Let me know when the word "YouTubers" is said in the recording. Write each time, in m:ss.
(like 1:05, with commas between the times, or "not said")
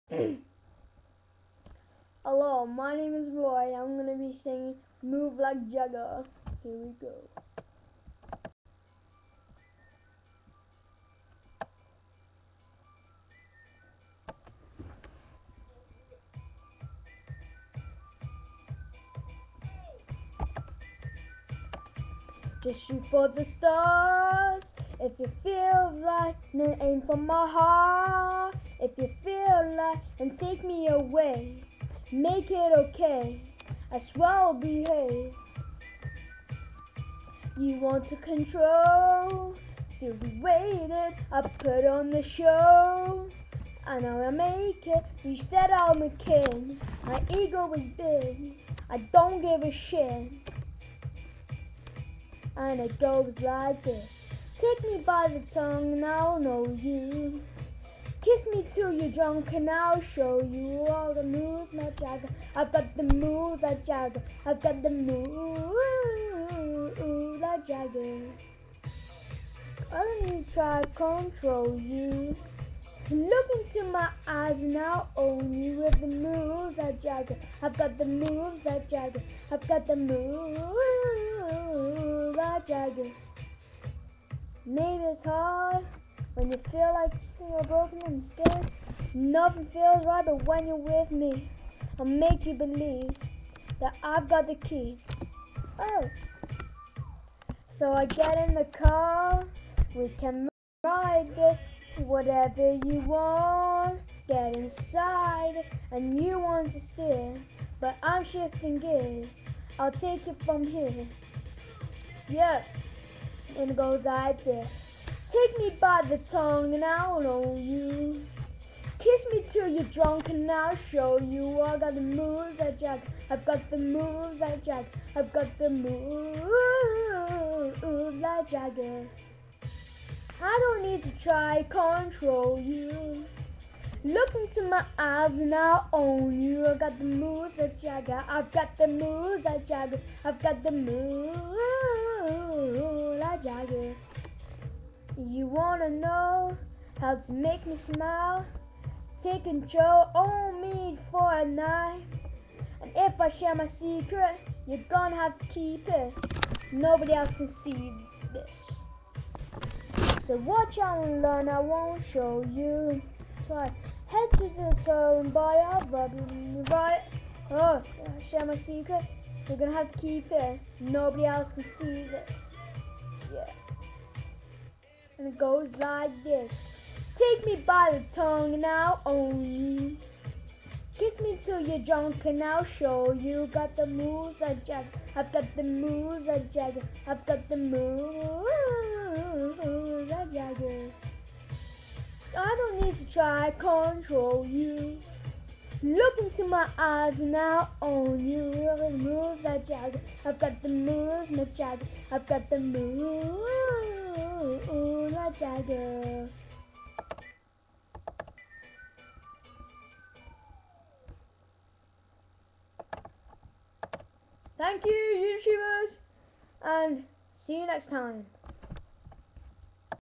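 3:35.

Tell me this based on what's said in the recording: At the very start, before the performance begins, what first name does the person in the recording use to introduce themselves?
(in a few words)
Roy.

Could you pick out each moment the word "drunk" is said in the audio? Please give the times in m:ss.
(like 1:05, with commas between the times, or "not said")
0:59, 1:59, 3:01.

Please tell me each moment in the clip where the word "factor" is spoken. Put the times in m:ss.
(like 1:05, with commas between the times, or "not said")
not said.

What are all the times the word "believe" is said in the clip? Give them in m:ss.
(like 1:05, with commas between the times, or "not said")
1:32.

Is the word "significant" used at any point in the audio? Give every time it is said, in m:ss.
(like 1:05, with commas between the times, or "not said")
not said.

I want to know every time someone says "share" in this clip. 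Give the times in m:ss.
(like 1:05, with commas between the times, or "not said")
2:33, 2:48.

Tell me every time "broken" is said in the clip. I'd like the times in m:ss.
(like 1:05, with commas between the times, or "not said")
1:27.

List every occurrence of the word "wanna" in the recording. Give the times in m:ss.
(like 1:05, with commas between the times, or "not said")
2:25.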